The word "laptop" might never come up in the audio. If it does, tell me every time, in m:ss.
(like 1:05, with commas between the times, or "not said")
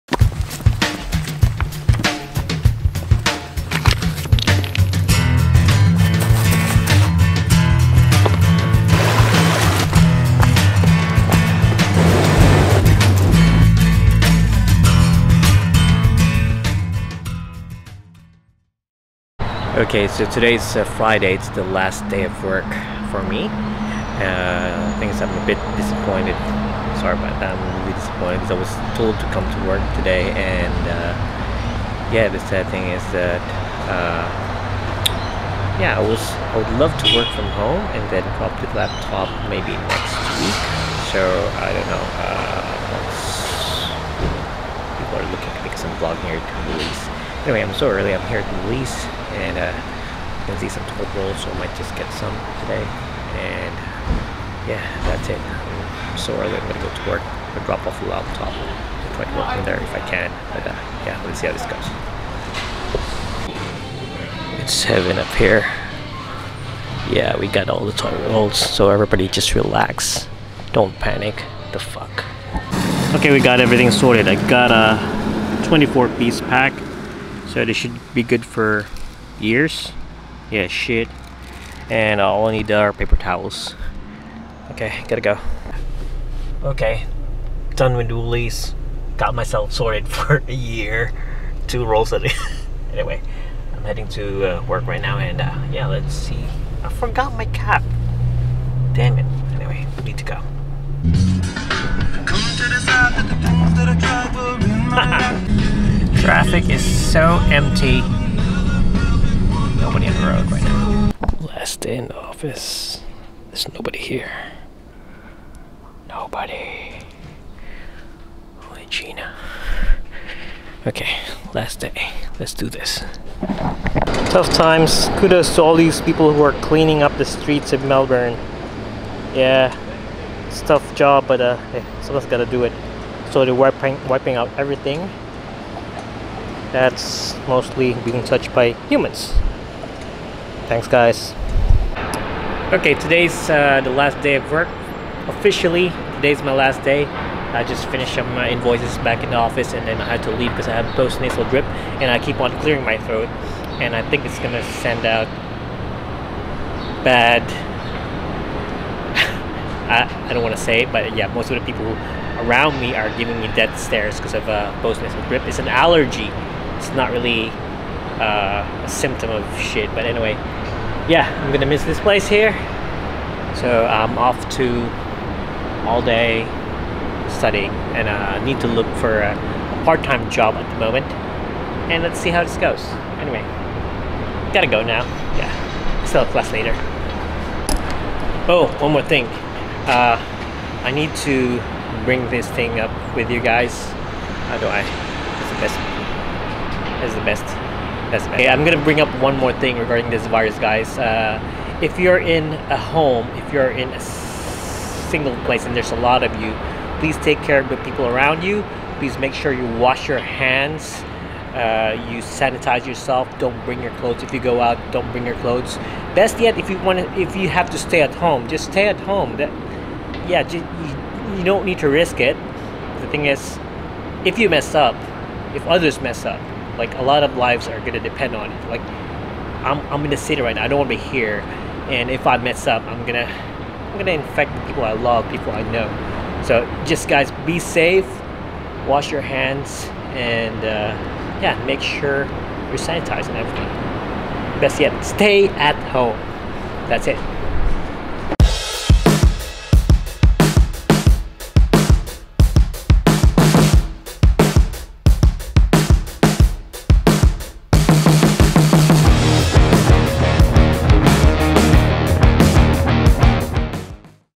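0:38, 0:58.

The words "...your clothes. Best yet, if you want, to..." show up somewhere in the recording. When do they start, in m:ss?
3:35.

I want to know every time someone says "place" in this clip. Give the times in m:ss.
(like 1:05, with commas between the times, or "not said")
2:51, 3:25.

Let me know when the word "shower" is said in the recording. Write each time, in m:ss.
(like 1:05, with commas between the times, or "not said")
not said.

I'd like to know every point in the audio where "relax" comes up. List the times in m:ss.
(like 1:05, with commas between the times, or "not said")
1:09.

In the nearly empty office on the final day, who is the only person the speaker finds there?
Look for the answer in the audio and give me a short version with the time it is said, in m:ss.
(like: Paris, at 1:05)
Gina, at 1:58.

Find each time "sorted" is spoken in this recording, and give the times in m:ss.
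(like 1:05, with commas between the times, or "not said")
1:13, 1:29.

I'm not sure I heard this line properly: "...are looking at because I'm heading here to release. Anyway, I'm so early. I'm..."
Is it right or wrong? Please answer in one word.
wrong.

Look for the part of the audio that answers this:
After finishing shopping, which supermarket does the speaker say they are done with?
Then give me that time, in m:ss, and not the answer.
1:28.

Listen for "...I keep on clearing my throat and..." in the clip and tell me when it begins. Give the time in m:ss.
2:32.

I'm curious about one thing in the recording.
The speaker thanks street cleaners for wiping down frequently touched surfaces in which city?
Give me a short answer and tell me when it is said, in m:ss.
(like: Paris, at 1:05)
Melbourne, at 2:07.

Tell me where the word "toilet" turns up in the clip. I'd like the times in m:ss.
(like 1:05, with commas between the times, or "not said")
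0:50, 1:07.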